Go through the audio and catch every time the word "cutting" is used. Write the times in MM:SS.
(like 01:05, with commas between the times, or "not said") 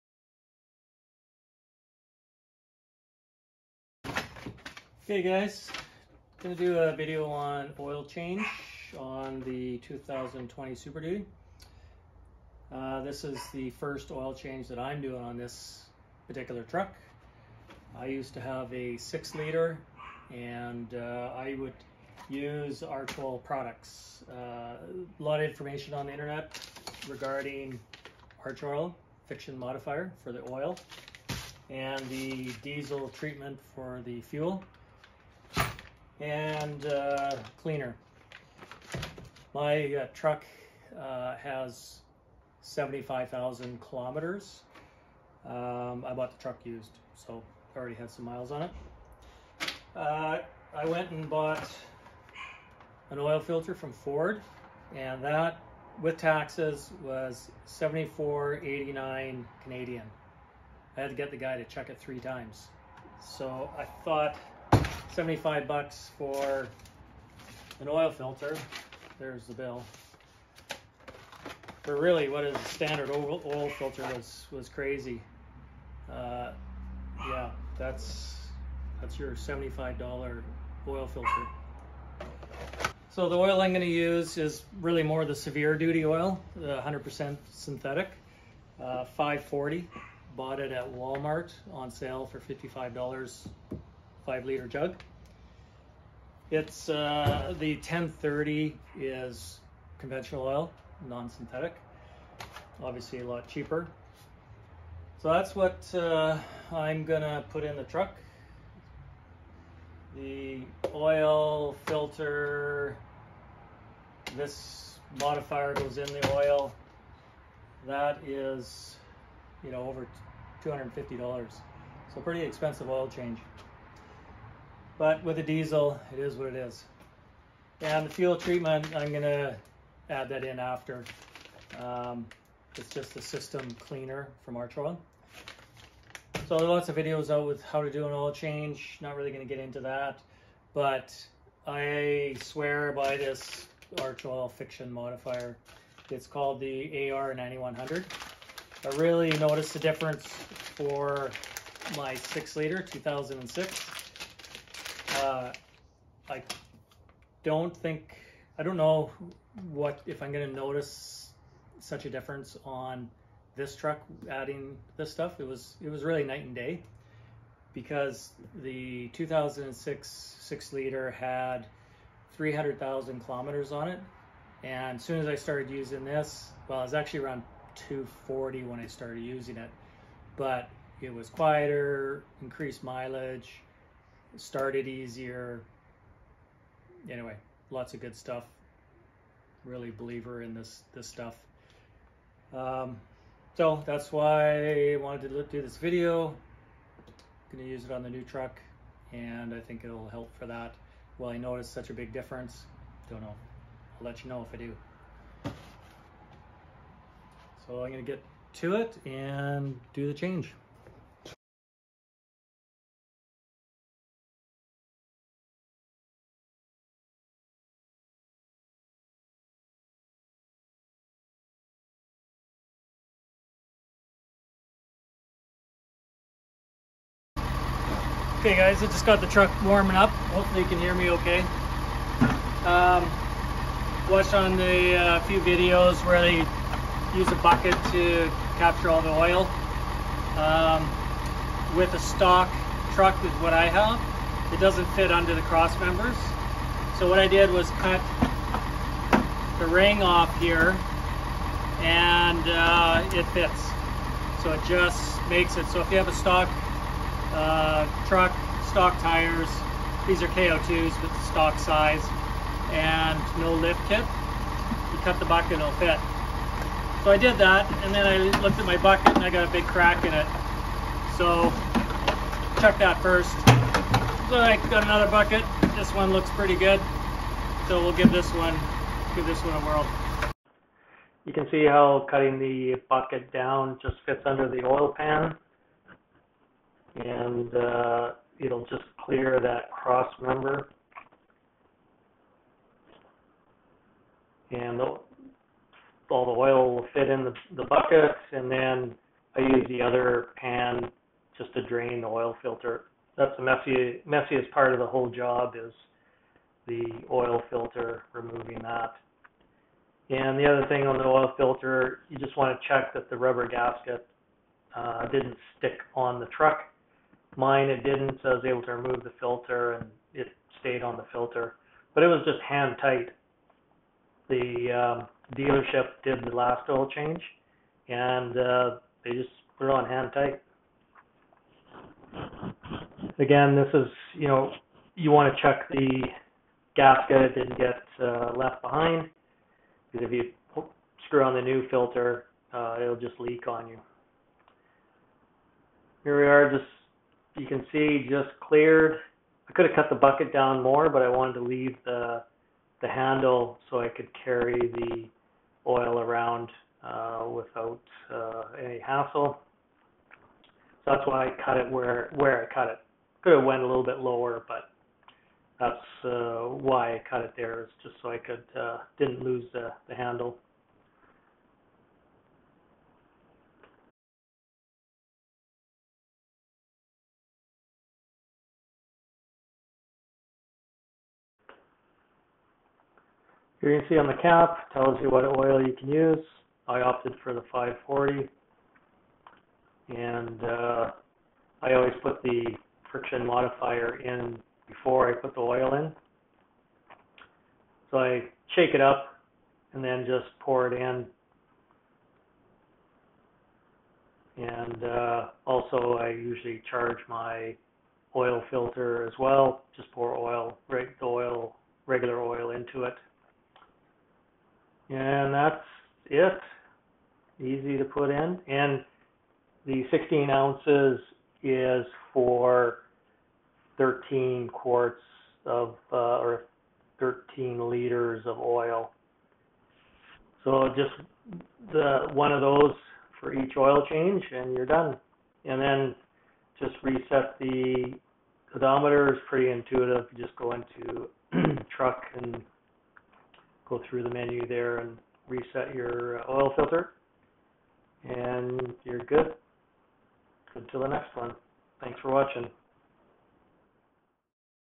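04:42.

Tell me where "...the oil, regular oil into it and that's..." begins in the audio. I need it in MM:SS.
06:50.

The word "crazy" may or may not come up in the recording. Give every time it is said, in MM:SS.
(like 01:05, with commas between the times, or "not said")
01:14.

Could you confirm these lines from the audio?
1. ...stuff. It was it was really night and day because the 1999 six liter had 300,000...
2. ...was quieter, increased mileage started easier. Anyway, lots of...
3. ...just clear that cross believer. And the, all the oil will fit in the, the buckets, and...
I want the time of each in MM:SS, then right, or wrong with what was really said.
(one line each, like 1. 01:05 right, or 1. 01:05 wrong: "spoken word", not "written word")
1. 02:45 wrong: "2006", not "1999"
2. 03:01 right
3. 04:48 wrong: "member", not "believer".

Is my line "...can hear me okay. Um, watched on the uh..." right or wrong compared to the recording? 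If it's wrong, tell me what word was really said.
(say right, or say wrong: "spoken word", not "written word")
right.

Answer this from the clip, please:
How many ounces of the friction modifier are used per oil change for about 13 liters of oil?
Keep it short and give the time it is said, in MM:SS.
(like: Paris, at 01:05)
16, at 06:59.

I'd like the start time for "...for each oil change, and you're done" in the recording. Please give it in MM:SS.
07:13.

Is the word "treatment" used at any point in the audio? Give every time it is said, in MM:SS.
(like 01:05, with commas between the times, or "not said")
00:33, 02:08.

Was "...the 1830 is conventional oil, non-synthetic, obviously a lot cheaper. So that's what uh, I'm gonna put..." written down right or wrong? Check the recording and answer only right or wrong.
wrong.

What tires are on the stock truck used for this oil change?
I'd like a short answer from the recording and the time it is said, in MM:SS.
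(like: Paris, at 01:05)
KO2s, at 04:20.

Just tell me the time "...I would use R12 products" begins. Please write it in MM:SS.
00:21.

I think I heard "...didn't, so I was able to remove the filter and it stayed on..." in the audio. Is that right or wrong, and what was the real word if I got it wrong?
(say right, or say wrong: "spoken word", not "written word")
right.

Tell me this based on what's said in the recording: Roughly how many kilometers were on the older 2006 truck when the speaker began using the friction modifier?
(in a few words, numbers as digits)
240,000.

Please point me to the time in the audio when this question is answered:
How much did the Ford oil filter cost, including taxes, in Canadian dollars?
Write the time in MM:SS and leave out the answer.
00:57.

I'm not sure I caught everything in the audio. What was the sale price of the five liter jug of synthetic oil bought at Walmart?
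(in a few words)
$55.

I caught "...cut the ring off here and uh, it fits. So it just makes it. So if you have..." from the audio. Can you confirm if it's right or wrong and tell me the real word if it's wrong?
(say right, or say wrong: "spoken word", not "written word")
right.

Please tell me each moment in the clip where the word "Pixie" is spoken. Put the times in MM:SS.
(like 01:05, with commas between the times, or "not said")
not said.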